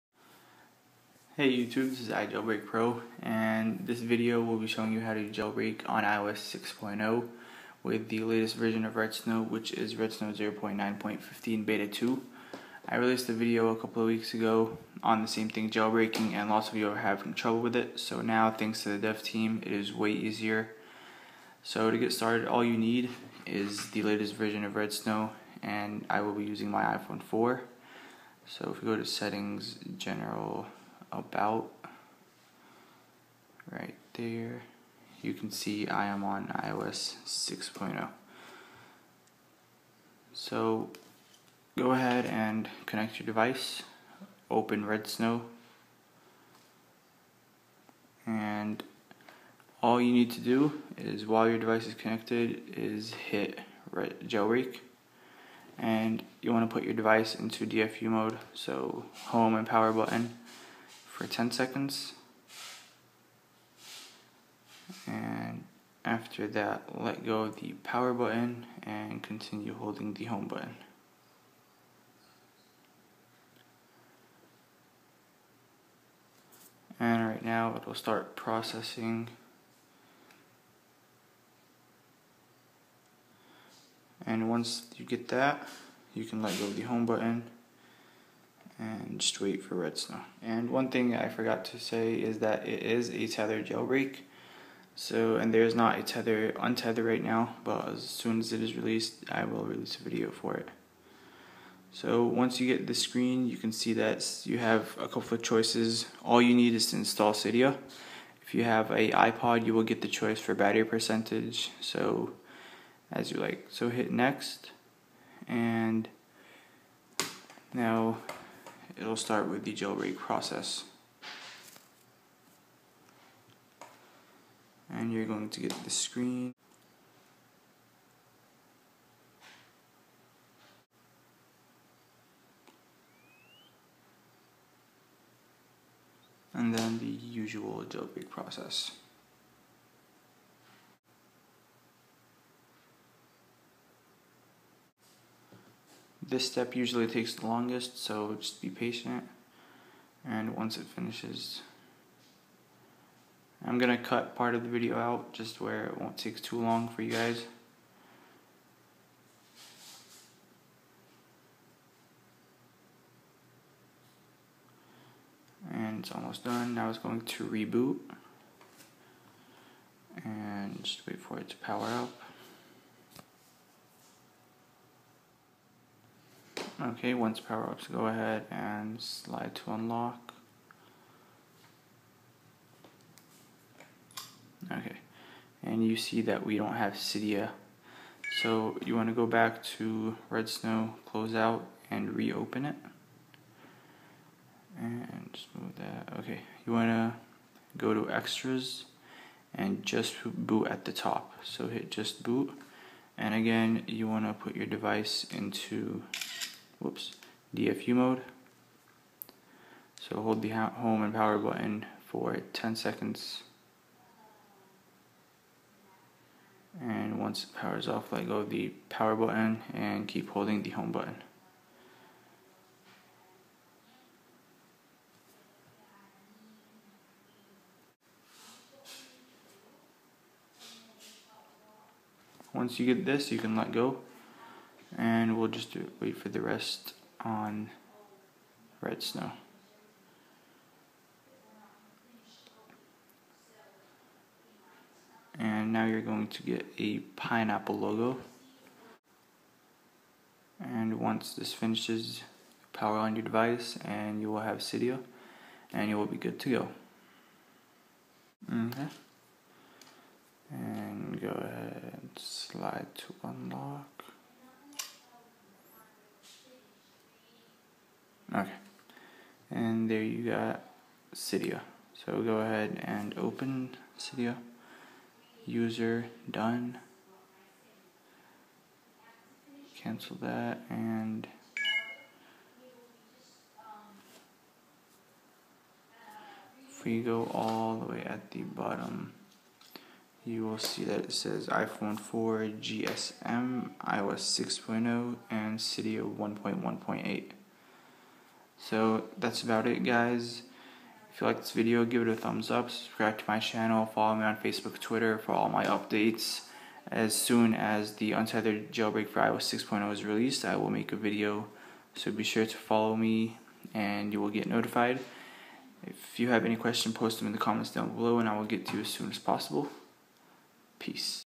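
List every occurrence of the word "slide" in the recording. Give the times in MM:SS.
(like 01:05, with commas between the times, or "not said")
02:58, 04:22.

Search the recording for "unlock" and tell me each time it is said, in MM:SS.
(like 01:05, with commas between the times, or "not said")
02:59, 04:23.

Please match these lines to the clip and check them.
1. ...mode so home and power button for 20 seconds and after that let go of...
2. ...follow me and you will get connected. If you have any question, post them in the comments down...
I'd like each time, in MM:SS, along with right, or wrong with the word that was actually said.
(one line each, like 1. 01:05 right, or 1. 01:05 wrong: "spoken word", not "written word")
1. 00:58 wrong: "10", not "20"
2. 05:12 wrong: "notified", not "connected".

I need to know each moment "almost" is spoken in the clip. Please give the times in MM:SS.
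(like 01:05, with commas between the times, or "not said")
02:46.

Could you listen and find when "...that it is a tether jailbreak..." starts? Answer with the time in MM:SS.
01:32.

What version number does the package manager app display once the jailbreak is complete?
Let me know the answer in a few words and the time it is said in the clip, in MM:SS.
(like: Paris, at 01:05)
1.1.8, at 04:56.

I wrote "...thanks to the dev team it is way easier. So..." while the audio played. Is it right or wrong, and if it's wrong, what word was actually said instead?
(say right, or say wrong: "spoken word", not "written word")
right.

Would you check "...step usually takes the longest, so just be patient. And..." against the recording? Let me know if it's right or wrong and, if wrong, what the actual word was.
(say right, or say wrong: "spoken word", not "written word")
right.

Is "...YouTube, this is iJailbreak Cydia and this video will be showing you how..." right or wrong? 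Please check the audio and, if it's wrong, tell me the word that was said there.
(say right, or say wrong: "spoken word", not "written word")
wrong: "Pro", not "Cydia".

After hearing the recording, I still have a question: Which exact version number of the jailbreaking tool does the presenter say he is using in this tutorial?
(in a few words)
0.9.15 Beta 2.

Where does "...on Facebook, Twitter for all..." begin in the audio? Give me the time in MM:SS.
05:04.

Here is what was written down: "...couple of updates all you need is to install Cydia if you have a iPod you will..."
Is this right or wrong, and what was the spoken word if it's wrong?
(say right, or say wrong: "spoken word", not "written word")
wrong: "choices", not "updates".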